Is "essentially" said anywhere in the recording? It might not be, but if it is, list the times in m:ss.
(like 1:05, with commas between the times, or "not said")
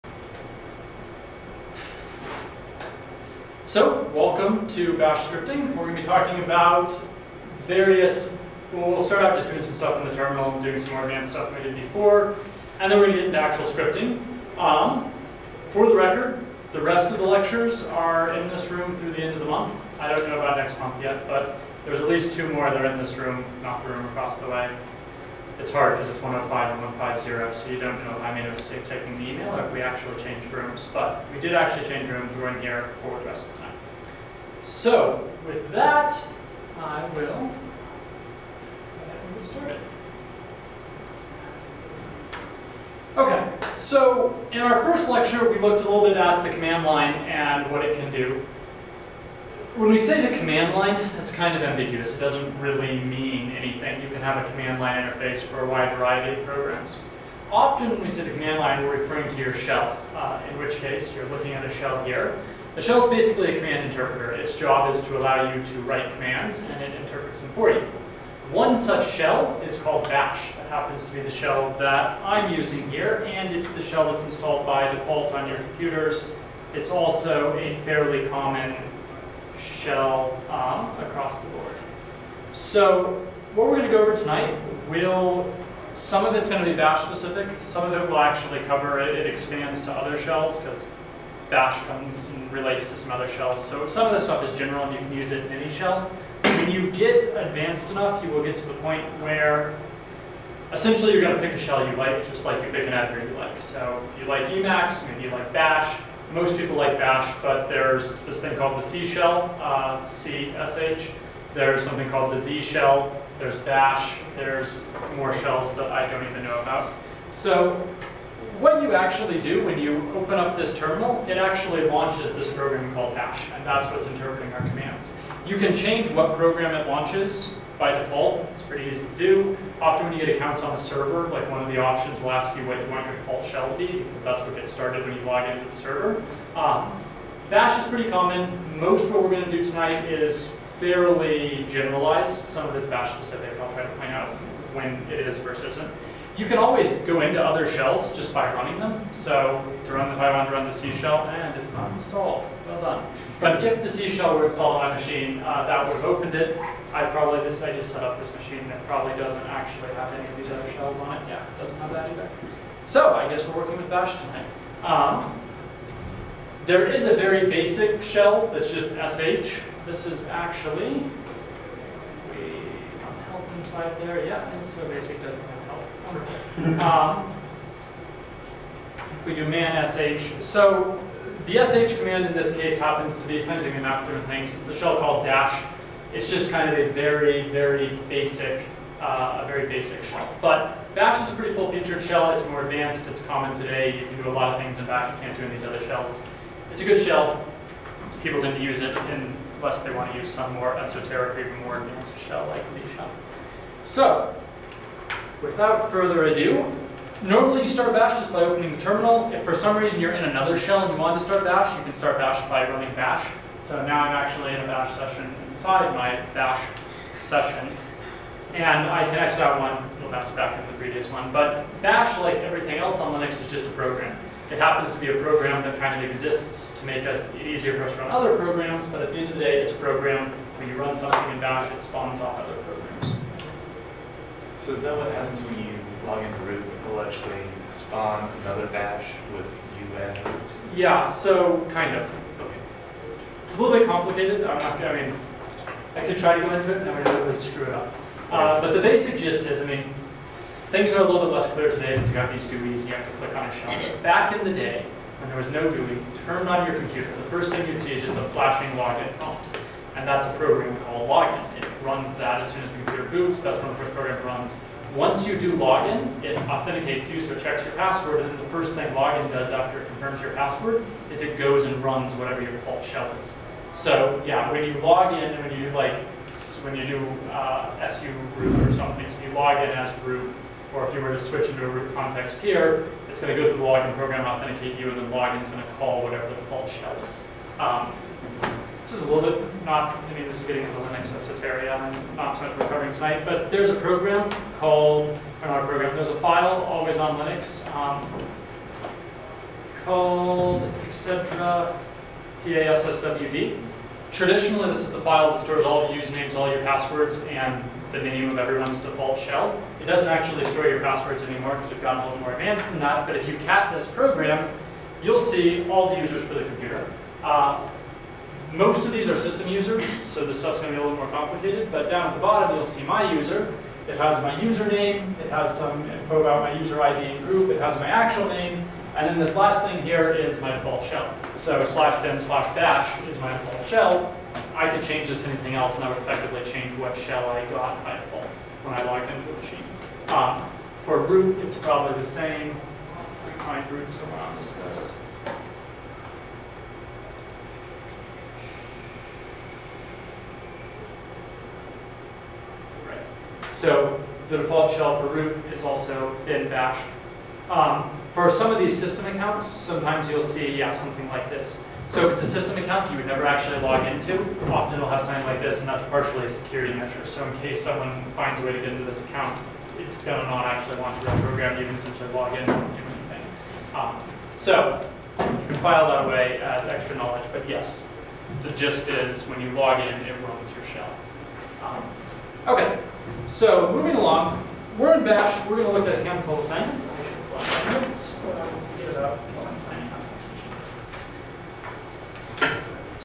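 1:40, 3:03, 6:11.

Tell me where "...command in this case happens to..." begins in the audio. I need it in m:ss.
3:01.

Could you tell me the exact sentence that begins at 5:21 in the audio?
But down at the bottom, you'll see my user.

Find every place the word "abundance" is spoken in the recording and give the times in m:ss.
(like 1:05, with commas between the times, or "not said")
not said.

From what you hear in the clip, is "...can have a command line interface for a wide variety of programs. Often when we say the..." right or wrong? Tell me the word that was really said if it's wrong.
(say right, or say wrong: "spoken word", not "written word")
right.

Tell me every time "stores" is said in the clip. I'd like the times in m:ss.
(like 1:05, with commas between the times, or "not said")
5:05, 5:10.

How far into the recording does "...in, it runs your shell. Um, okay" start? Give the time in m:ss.
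6:19.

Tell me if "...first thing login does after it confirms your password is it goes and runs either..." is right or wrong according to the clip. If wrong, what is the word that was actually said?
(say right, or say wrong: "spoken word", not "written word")
wrong: "whatever", not "either".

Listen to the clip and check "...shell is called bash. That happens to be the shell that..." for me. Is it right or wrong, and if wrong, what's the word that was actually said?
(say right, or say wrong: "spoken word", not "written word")
right.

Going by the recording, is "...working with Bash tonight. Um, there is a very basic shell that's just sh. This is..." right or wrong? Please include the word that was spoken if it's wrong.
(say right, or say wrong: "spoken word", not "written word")
right.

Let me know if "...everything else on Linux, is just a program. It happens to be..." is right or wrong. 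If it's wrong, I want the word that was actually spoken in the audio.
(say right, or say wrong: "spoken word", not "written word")
right.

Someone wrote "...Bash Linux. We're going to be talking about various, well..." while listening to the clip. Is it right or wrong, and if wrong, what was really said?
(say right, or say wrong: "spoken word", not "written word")
wrong: "Scripting", not "Linux".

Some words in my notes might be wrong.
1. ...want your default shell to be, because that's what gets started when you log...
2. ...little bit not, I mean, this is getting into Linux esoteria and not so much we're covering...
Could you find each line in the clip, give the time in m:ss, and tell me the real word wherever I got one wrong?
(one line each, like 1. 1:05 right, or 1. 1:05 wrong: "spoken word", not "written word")
1. 2:12 right
2. 4:49 right.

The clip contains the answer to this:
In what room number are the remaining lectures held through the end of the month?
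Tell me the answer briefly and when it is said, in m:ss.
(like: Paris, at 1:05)
105, at 0:26.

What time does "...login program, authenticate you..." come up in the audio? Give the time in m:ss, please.
4:43.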